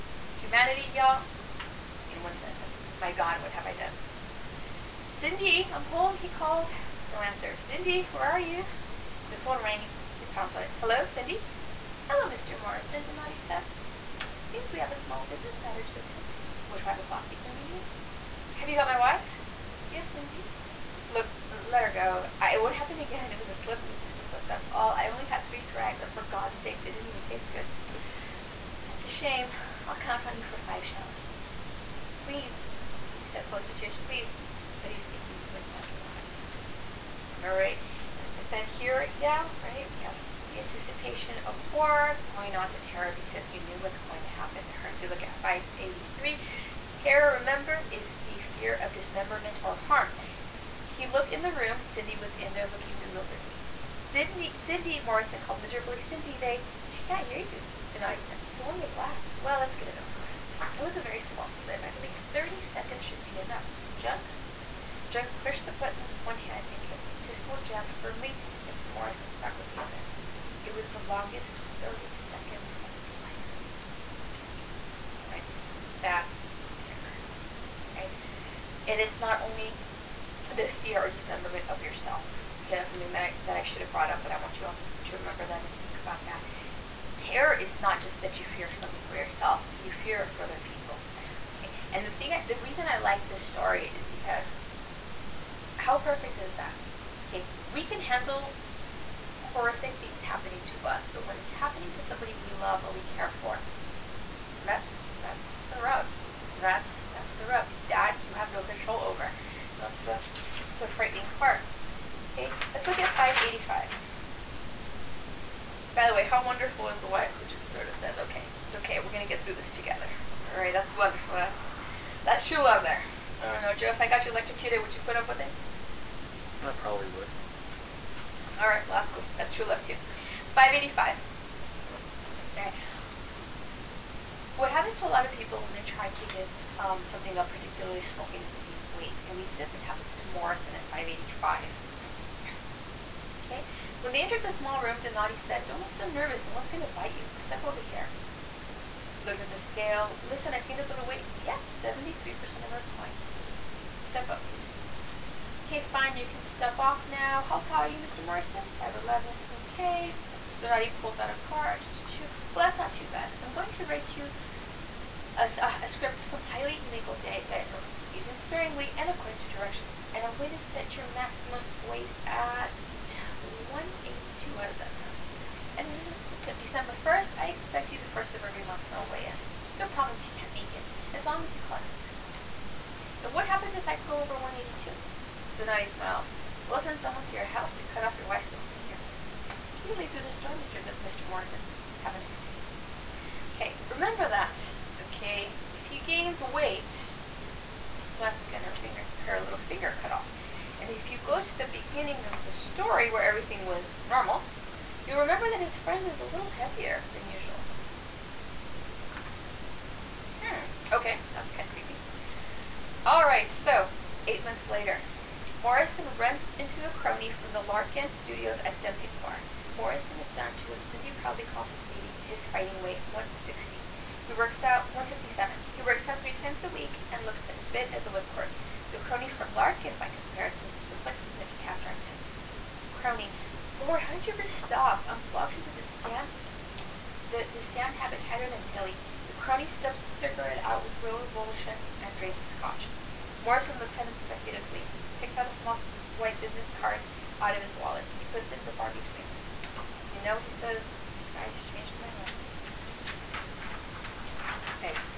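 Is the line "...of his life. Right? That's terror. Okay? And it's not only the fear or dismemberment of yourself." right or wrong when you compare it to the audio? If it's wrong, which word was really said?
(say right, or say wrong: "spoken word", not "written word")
right.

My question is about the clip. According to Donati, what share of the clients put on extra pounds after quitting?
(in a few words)
73%.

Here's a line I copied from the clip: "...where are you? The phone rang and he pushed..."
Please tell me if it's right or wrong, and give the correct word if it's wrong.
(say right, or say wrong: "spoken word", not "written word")
wrong: "pounced", not "pushed".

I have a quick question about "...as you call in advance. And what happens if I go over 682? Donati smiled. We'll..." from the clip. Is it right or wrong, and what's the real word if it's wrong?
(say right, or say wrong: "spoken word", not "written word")
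wrong: "182", not "682".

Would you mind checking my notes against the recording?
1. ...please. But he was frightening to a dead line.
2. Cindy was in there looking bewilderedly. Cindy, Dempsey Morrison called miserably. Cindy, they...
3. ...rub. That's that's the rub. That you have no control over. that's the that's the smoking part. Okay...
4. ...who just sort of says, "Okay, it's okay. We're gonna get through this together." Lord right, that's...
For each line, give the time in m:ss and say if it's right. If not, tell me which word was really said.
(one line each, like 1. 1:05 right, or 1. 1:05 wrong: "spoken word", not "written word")
1. 0:34 wrong: "speaking", not "frightening"
2. 0:51 wrong: "Cindy", not "Dempsey"
3. 1:45 wrong: "frightening", not "smoking"
4. 1:57 wrong: "All", not "Lord".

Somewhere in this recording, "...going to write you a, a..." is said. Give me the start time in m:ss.
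2:43.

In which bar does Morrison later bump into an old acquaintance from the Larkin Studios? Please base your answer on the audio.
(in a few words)
Dempsey's Bar.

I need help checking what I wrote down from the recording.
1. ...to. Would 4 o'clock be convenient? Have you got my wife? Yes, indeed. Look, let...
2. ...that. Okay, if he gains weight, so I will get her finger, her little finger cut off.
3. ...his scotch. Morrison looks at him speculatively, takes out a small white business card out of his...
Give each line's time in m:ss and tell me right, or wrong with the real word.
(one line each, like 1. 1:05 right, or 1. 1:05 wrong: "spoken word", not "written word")
1. 0:16 wrong: "5", not "4"
2. 3:14 right
3. 4:02 right.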